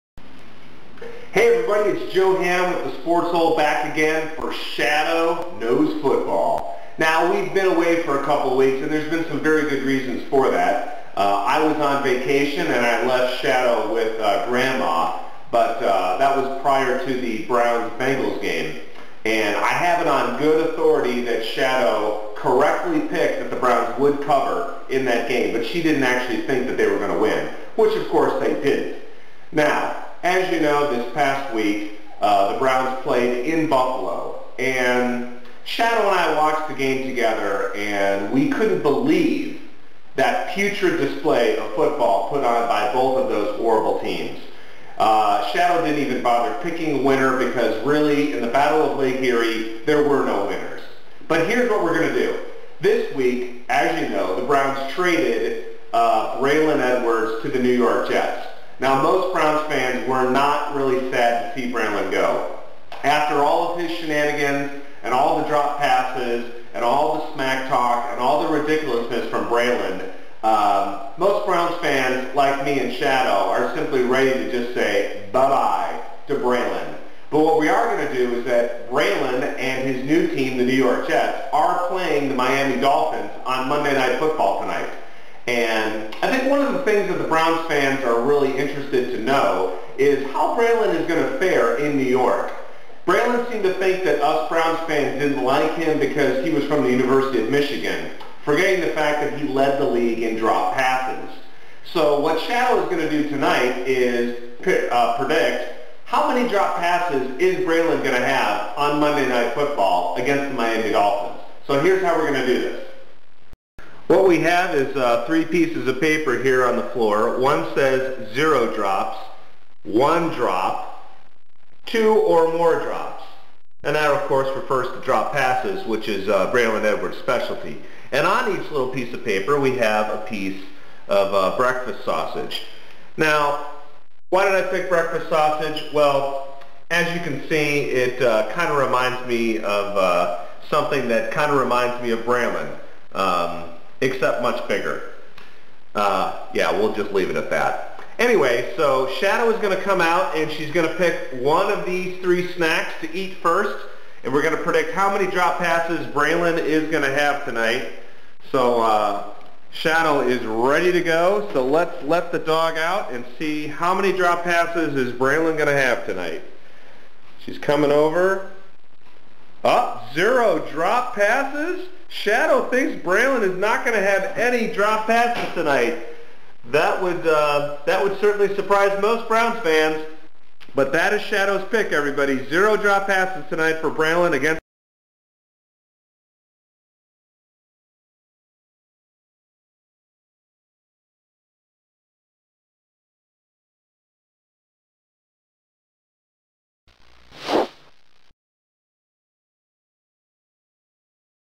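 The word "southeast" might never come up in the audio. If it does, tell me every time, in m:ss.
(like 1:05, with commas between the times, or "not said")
not said.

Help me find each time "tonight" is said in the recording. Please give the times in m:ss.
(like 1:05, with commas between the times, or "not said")
1:24, 1:43, 2:37, 2:46, 2:55, 3:03.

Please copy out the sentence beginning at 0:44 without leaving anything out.
Uh, Shadow didn't even bother picking a winner because really, in the Battle of Lake Erie, there were no winners.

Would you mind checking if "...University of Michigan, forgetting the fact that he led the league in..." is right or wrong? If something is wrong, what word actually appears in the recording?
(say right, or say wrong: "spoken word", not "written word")
right.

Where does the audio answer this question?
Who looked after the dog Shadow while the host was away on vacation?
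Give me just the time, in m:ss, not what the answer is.
0:14.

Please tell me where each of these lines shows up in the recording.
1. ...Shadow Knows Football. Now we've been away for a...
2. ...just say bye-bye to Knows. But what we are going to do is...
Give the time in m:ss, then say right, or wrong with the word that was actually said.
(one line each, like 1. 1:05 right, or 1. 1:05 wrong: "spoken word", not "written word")
1. 0:04 right
2. 1:14 wrong: "Braylon", not "Knows".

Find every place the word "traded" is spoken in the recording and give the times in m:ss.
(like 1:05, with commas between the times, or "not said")
0:54.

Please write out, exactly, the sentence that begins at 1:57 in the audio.
One says zero drops, one drop, two or more drops.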